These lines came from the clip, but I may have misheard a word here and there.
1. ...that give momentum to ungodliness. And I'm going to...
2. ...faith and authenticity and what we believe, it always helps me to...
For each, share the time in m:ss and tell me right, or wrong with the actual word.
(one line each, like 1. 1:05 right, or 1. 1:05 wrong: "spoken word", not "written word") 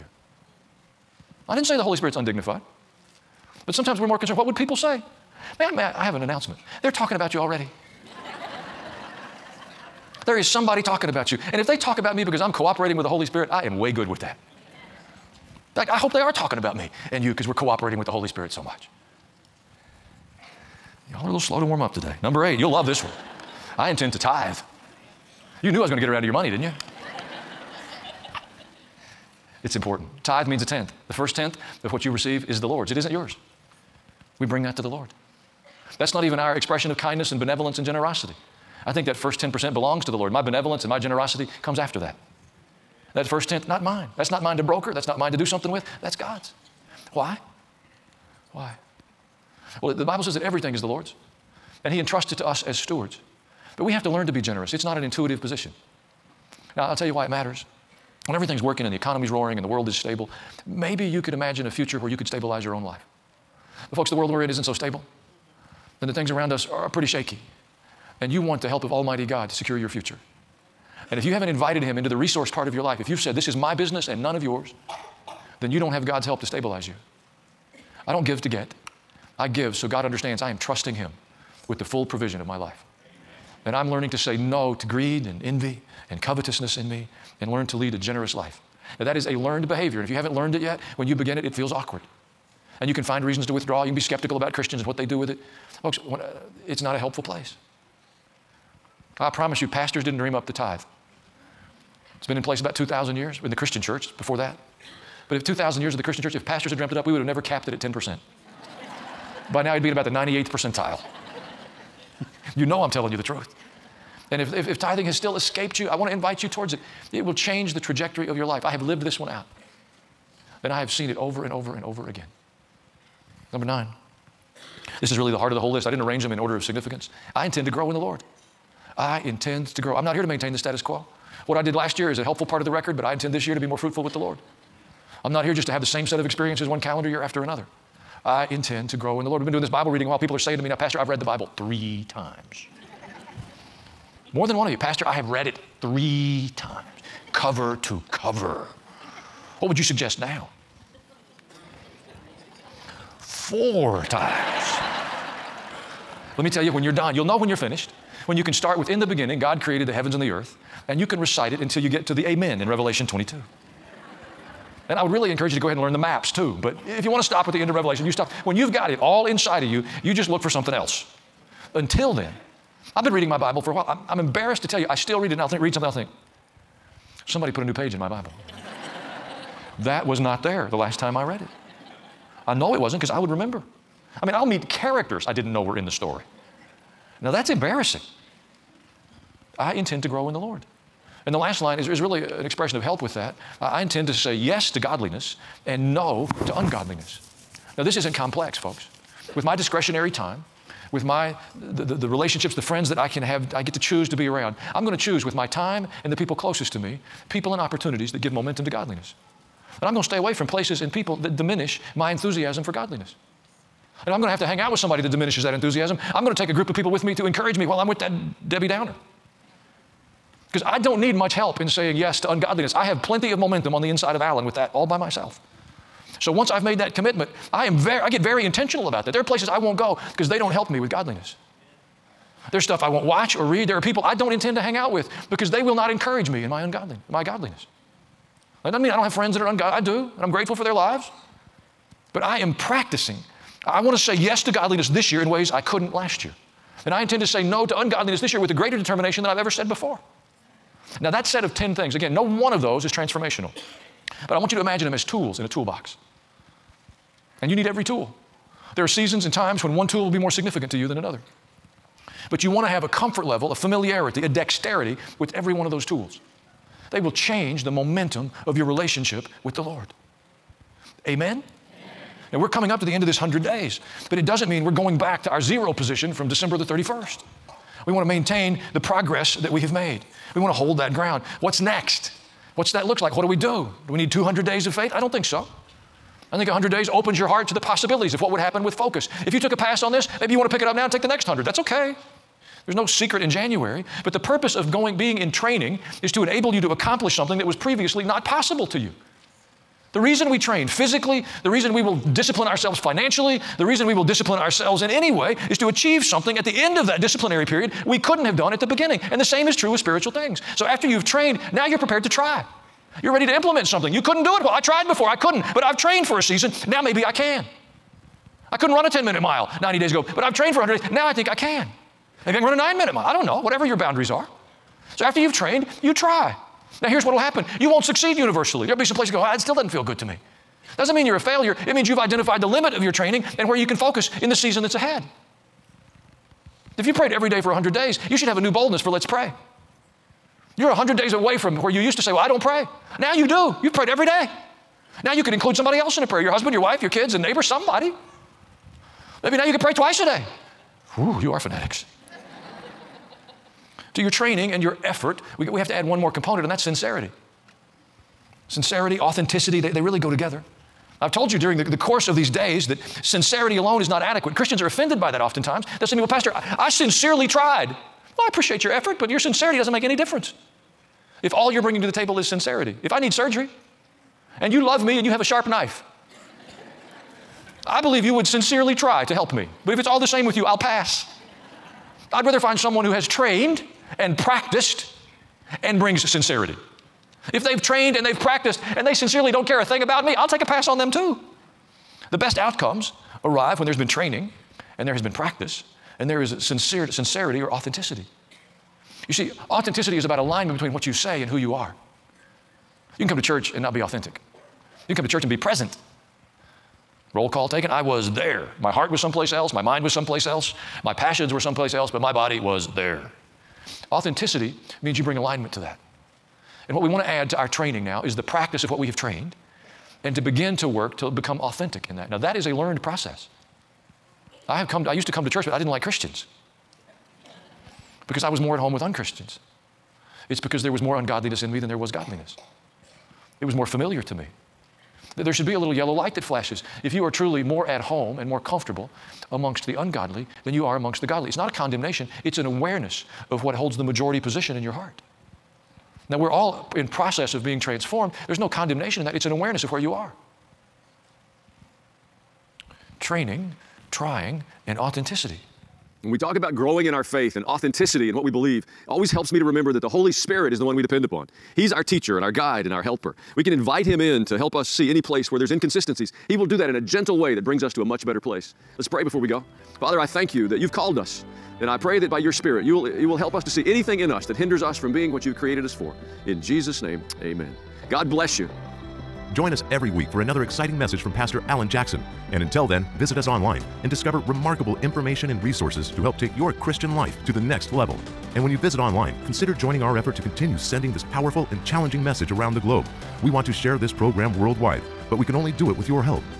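1. 3:28 wrong: "godliness", not "ungodliness"
2. 7:37 right.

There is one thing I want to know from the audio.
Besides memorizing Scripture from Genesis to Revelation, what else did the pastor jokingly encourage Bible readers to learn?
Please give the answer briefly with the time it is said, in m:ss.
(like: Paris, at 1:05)
the maps, at 2:45.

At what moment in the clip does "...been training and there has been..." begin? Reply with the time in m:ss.
6:33.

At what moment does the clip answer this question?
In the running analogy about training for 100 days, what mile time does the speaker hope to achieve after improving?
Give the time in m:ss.
5:22.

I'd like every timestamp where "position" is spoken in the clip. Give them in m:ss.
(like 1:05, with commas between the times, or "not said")
0:55, 4:35, 7:24.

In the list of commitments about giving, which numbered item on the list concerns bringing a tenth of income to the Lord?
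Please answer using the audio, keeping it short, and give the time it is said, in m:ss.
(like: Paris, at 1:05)
8, at 0:22.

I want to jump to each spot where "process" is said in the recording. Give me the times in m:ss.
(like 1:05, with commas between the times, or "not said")
7:02, 7:26.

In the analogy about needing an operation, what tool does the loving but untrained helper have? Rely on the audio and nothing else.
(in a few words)
a sharp knife.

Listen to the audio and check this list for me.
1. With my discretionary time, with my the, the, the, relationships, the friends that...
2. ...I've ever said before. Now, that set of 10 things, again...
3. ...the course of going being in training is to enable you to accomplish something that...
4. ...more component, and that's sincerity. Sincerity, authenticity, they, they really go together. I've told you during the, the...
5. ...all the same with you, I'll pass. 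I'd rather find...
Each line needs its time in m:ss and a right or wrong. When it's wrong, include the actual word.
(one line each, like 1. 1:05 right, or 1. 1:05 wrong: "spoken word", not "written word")
1. 3:19 right
2. 4:09 right
3. 4:54 wrong: "purpose", not "course"
4. 5:55 right
5. 6:19 right.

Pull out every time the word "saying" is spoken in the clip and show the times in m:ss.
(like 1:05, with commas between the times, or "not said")
2:20, 3:41.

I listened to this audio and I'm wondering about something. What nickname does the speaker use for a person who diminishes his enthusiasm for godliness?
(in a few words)
Debbie Downer.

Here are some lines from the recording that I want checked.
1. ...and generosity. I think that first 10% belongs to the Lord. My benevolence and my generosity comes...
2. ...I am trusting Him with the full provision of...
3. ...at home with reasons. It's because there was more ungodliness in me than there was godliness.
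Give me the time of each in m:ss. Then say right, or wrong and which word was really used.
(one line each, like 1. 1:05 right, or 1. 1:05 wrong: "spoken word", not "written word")
1. 0:37 right
2. 1:20 right
3. 7:08 wrong: "unchristians", not "reasons".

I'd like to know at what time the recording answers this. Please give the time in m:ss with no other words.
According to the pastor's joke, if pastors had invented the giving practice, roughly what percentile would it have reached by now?
1:50.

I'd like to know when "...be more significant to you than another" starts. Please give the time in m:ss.
4:20.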